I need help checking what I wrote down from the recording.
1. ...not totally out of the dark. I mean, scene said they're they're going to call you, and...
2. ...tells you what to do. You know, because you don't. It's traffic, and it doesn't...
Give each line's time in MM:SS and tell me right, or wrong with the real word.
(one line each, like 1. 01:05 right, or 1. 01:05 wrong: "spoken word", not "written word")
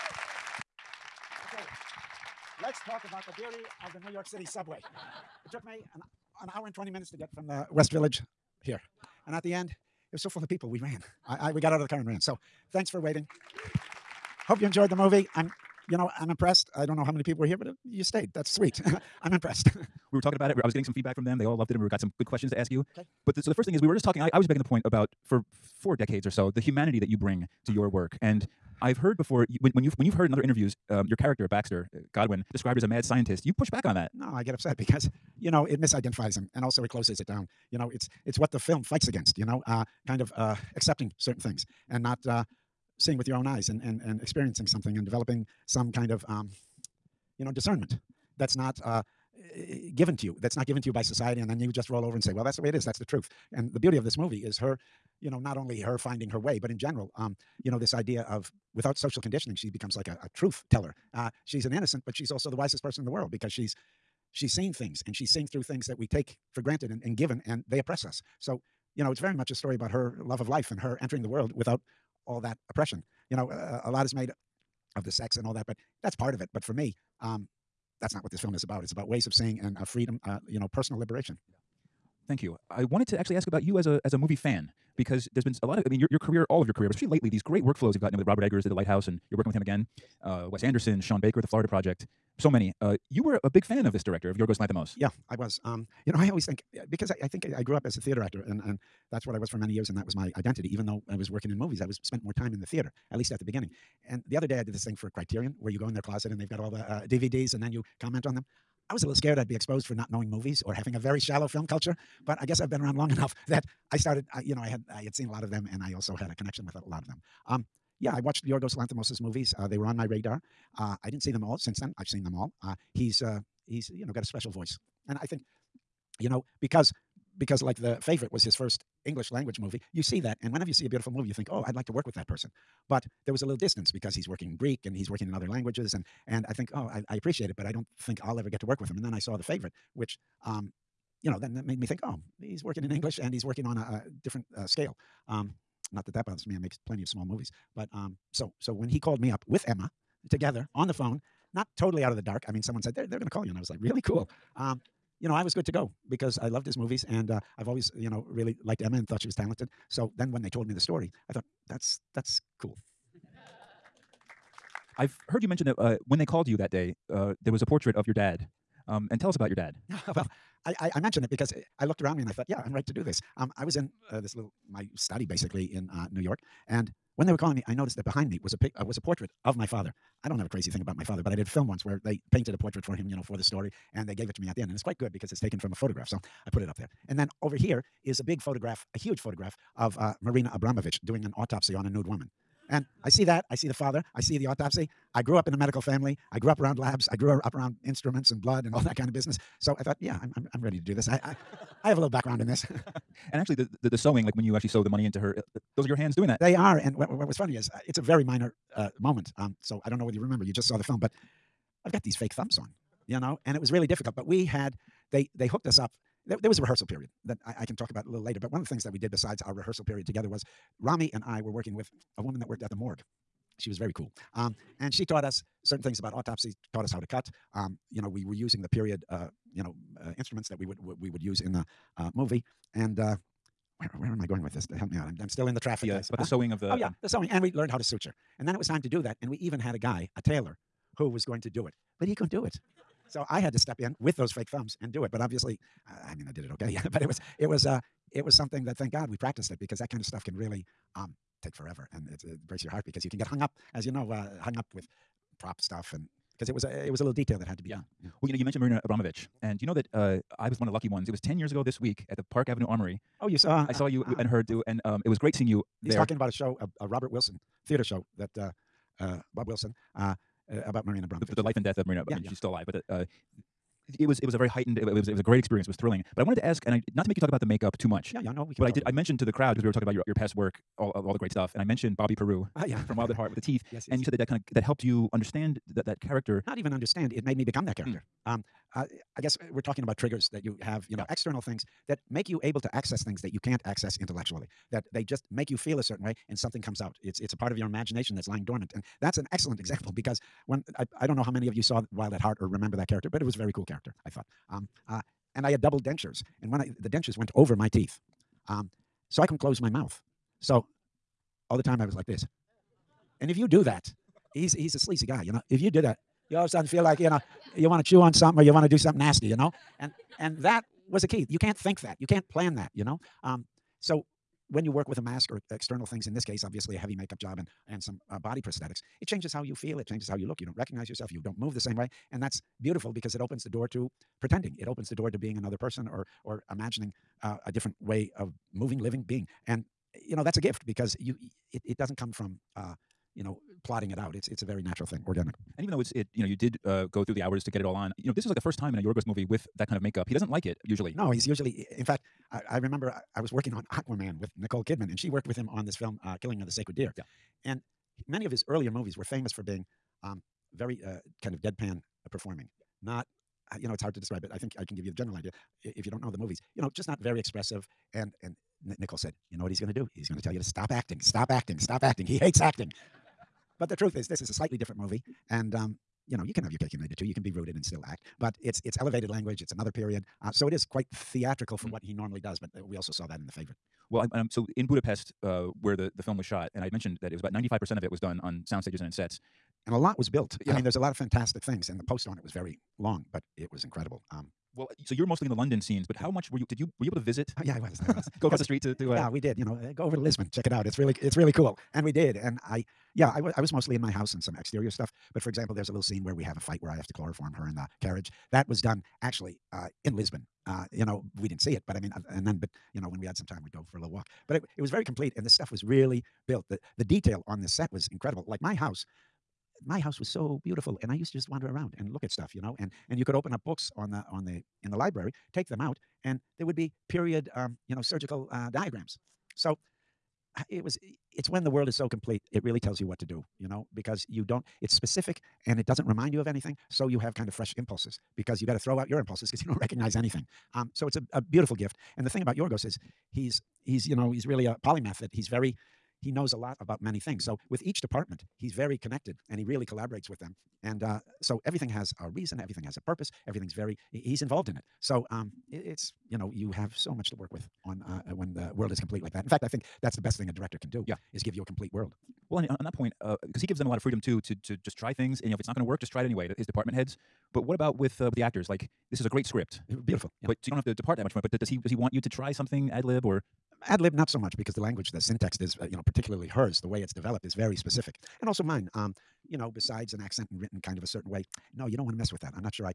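1. 02:31 wrong: "someone", not "scene"
2. 07:12 wrong: "specific", not "traffic".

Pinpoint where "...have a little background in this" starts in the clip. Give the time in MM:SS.
03:21.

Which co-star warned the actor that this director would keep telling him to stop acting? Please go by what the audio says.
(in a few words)
Nicole Kidman.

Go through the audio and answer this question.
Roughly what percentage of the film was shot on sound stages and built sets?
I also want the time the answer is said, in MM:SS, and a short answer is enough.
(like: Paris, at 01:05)
95 percent, at 06:27.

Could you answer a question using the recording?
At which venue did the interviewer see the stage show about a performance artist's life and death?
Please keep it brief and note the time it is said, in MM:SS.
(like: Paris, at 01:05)
Park Avenue Armory, at 04:22.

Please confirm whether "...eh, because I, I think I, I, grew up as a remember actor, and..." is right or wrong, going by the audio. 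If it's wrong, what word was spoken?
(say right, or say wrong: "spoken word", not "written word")
wrong: "theater", not "remember".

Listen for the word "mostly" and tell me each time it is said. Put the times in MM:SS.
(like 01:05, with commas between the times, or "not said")
06:35, 06:43.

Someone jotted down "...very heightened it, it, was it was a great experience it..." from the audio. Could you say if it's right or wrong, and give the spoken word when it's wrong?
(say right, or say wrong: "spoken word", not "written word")
right.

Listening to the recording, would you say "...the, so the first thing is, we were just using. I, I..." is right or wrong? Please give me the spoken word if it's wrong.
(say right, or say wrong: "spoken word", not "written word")
wrong: "talking", not "using".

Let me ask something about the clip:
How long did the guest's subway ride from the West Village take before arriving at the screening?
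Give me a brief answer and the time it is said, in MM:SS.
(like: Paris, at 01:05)
1 hour 20 minutes, at 00:06.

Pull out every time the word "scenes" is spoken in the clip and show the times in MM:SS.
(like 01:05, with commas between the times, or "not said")
06:35, 06:45.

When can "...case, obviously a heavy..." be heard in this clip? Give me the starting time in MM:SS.
05:26.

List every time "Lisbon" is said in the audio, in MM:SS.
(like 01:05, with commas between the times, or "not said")
06:39, 06:49.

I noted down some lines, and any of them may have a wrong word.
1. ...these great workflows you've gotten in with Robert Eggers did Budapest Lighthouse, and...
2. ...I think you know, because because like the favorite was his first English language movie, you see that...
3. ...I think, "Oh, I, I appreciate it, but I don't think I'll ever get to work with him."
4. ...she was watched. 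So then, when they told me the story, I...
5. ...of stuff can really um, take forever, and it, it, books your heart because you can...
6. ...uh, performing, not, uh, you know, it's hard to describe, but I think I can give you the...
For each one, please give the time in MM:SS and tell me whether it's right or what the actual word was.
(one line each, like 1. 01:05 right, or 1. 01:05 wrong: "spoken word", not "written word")
1. 01:27 wrong: "The", not "Budapest"
2. 02:05 right
3. 02:16 right
4. 02:39 wrong: "talented", not "watched"
5. 04:10 wrong: "breaks", not "books"
6. 06:02 right.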